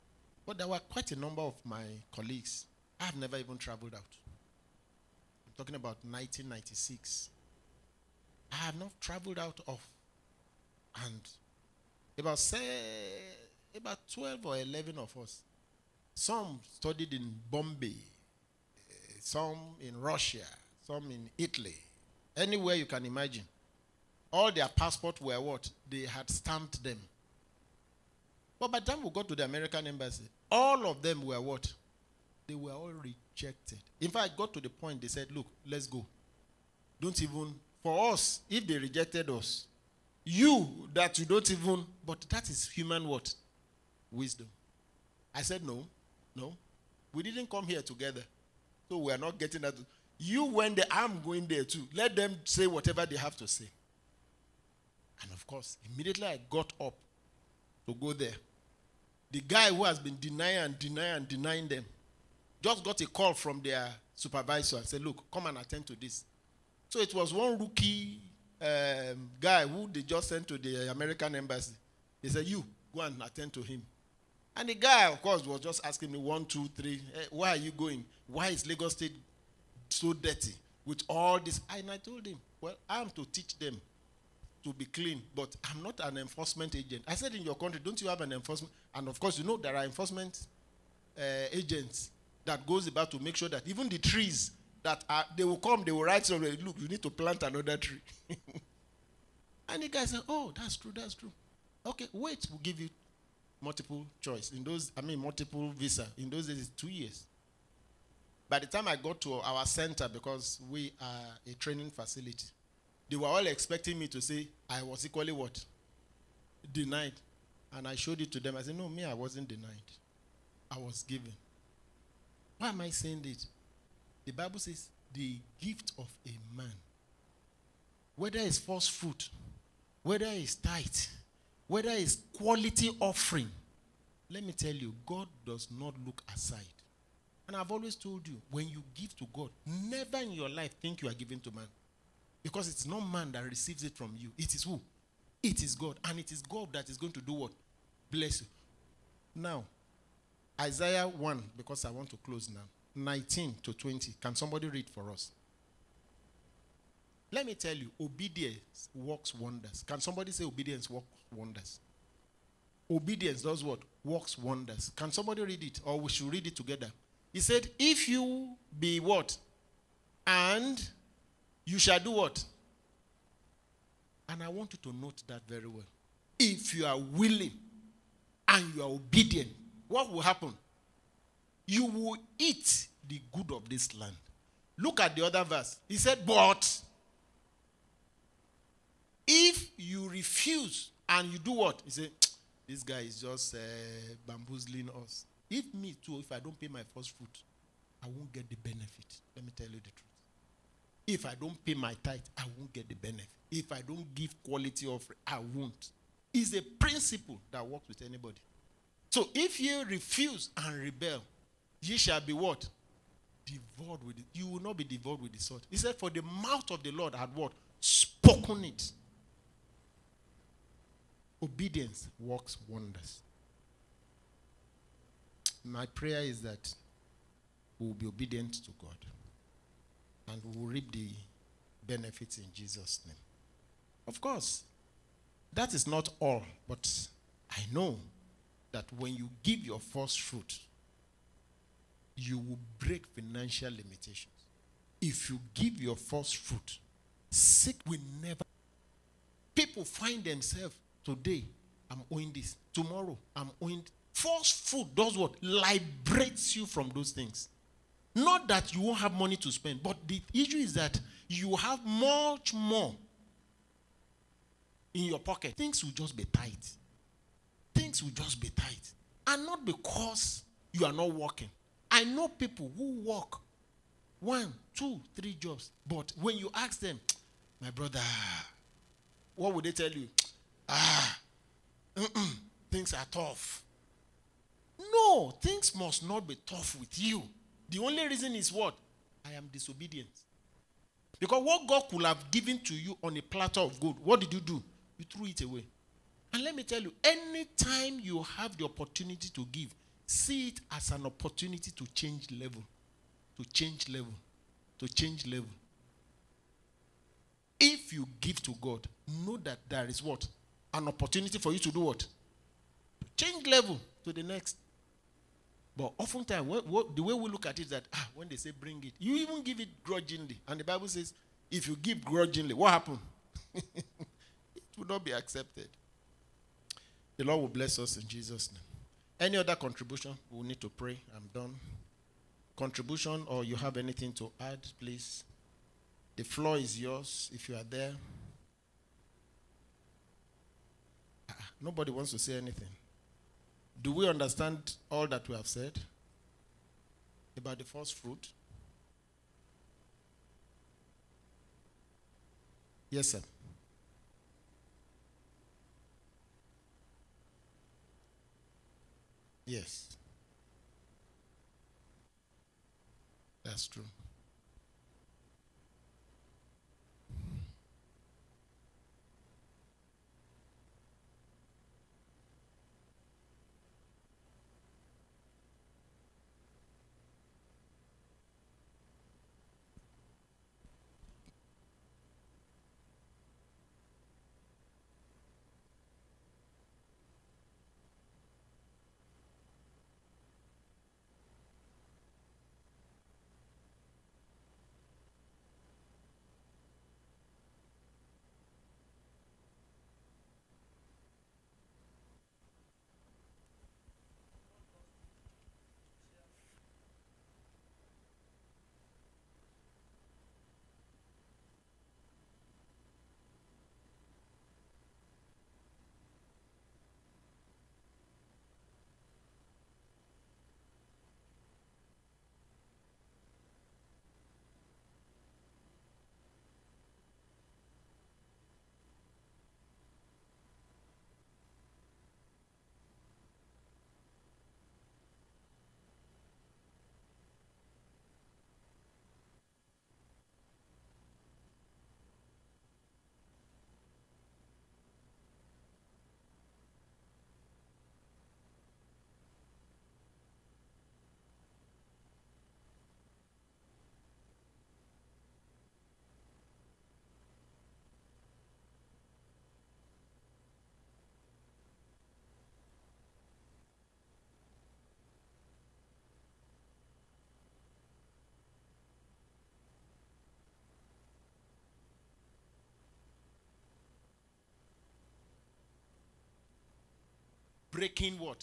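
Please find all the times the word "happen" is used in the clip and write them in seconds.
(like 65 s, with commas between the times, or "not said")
180 s, 322 s.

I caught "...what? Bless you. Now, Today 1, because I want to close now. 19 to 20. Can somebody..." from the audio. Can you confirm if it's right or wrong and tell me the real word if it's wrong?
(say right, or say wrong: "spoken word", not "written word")
wrong: "Isaiah", not "Today".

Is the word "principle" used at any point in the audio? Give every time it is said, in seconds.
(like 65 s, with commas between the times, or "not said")
206 s.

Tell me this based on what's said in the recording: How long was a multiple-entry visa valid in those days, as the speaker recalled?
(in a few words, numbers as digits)
2 years.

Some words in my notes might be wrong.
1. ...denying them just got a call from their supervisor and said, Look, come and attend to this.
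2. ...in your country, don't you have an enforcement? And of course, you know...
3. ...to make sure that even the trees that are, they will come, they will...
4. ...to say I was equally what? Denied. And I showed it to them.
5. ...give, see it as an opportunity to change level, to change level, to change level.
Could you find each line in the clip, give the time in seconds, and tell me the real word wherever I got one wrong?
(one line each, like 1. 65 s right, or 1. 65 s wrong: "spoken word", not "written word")
1. 61 s right
2. 87 s right
3. 93 s right
4. 114 s right
5. 299 s right.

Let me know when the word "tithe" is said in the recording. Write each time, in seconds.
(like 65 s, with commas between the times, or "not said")
130 s, 202 s.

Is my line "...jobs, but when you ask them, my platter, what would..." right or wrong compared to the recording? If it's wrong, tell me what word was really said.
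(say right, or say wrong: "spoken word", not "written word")
wrong: "brother", not "platter".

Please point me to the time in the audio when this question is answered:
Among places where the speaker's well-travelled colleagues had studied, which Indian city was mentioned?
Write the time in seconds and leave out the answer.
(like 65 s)
17 s.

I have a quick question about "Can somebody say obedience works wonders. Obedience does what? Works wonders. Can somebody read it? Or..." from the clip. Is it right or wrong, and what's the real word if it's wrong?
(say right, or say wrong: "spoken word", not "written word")
right.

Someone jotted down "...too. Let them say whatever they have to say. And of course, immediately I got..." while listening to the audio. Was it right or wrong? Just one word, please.
right.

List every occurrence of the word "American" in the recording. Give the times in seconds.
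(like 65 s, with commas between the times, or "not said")
29 s, 70 s.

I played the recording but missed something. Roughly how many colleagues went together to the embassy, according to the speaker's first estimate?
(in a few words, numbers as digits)
12.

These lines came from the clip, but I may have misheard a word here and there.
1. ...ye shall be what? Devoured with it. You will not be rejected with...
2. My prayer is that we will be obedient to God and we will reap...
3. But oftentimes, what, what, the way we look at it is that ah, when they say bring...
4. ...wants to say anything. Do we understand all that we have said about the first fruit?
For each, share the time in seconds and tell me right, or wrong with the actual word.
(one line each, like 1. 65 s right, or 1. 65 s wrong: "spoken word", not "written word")
1. 211 s wrong: "devoured", not "rejected"
2. 225 s right
3. 315 s right
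4. 341 s right.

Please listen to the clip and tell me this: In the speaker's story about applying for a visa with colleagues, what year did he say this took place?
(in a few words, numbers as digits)
1996.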